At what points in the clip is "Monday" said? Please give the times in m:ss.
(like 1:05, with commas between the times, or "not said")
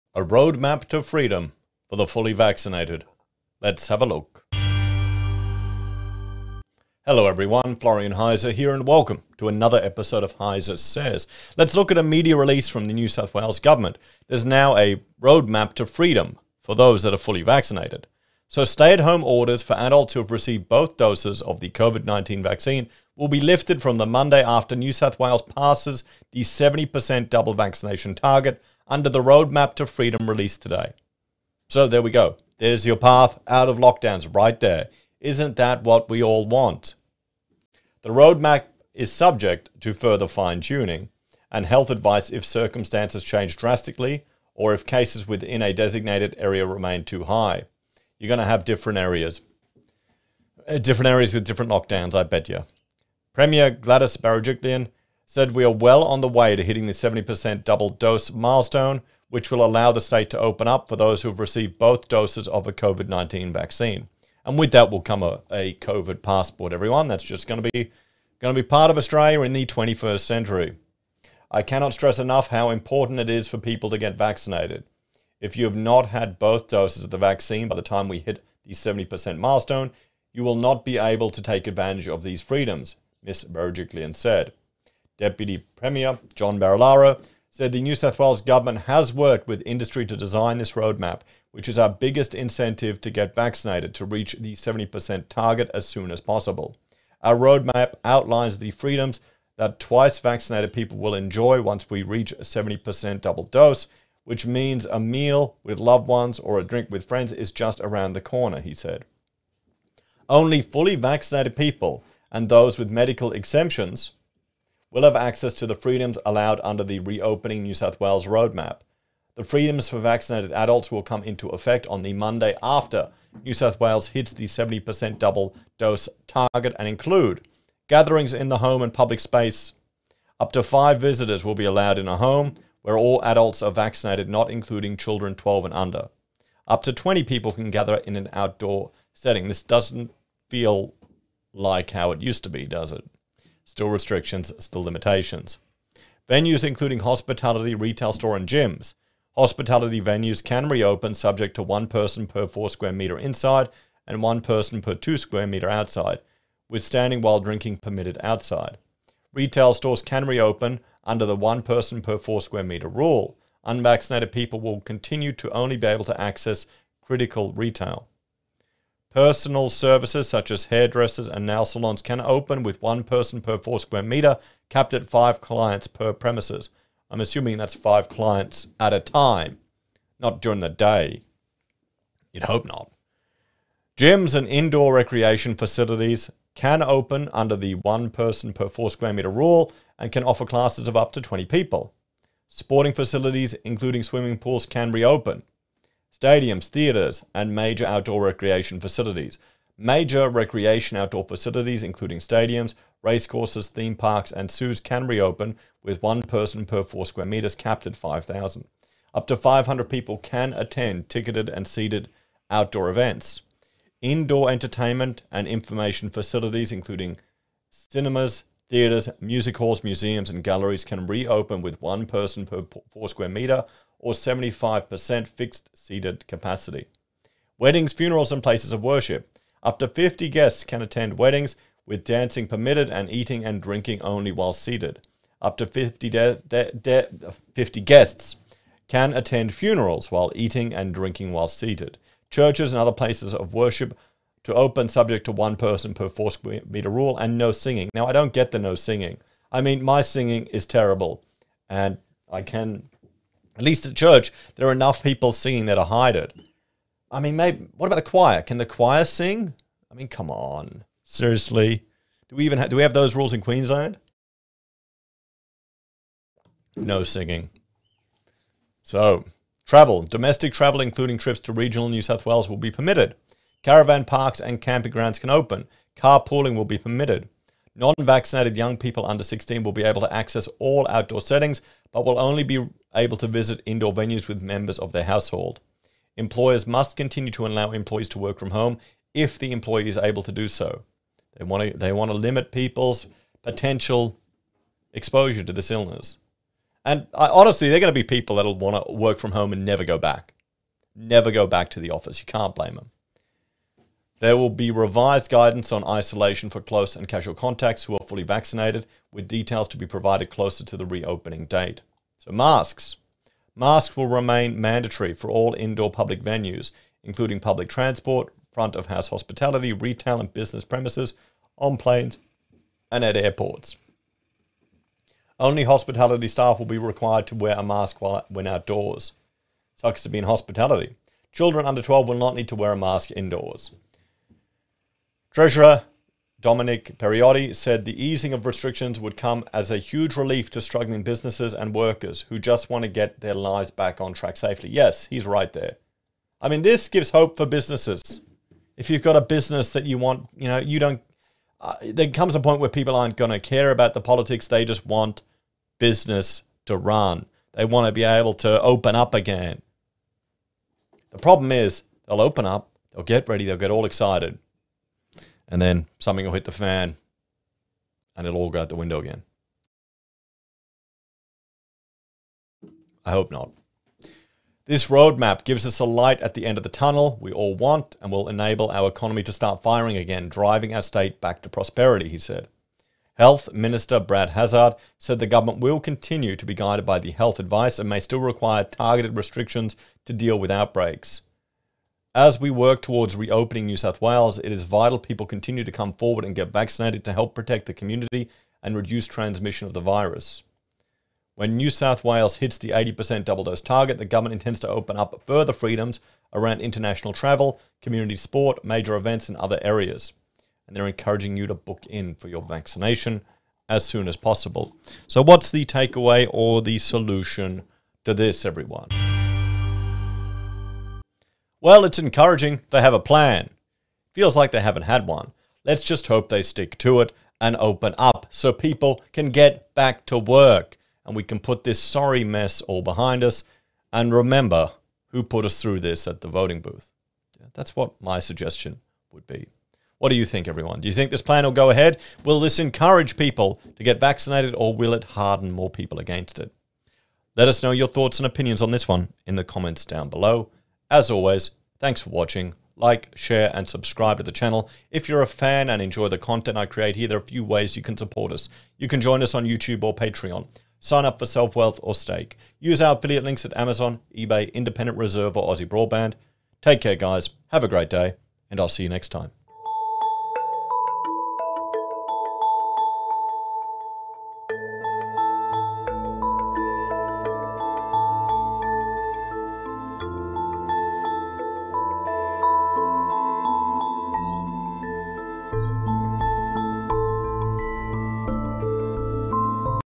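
0:24, 2:02.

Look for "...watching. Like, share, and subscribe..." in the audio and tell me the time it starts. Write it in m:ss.
7:32.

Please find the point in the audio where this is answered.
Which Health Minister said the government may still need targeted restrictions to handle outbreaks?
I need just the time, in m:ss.
6:23.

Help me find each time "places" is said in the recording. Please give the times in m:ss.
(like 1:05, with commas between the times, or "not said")
3:48, 4:02.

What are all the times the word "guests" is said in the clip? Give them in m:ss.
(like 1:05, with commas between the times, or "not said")
3:50, 3:57.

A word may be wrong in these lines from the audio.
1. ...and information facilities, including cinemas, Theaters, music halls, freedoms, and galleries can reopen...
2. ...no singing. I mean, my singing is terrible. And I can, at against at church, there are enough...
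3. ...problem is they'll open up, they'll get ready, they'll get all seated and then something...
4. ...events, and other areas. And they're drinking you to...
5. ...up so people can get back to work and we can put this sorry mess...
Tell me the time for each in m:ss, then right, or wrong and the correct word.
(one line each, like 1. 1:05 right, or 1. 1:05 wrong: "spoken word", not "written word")
1. 3:35 wrong: "museums", not "freedoms"
2. 4:08 wrong: "least", not "against"
3. 6:01 wrong: "excited", not "seated"
4. 6:48 wrong: "encouraging", not "drinking"
5. 7:07 right.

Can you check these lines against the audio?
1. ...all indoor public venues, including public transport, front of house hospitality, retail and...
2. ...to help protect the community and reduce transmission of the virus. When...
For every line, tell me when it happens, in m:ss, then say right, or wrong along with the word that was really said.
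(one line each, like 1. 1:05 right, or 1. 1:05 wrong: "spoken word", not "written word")
1. 5:15 right
2. 6:37 right.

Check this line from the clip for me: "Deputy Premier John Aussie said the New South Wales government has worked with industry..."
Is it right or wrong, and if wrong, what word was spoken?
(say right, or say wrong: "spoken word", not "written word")
wrong: "Barilaro", not "Aussie".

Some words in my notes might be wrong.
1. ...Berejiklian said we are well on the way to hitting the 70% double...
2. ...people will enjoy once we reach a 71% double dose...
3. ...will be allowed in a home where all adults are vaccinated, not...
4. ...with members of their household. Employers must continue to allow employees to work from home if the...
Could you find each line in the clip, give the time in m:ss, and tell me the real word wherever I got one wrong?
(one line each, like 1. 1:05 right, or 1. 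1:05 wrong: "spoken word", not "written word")
1. 0:54 right
2. 1:40 wrong: "70", not "71"
3. 2:11 right
4. 4:44 right.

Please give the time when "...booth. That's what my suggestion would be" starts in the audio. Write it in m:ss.
7:16.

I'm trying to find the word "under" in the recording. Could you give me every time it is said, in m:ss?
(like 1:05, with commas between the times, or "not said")
0:28, 1:56, 2:15, 2:41, 3:07, 4:39, 5:31.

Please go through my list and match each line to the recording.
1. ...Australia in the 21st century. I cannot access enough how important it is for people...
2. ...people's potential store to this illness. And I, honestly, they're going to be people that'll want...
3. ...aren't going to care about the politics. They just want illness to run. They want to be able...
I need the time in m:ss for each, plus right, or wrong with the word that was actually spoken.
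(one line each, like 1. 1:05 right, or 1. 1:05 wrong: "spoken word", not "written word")
1. 1:08 wrong: "stress", not "access"
2. 4:52 wrong: "exposure", not "store"
3. 5:52 wrong: "business", not "illness".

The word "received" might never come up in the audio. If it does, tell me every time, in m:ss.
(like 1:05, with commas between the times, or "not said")
0:20, 1:01.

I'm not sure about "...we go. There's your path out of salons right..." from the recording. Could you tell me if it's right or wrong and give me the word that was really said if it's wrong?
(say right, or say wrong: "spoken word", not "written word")
wrong: "lockdowns", not "salons".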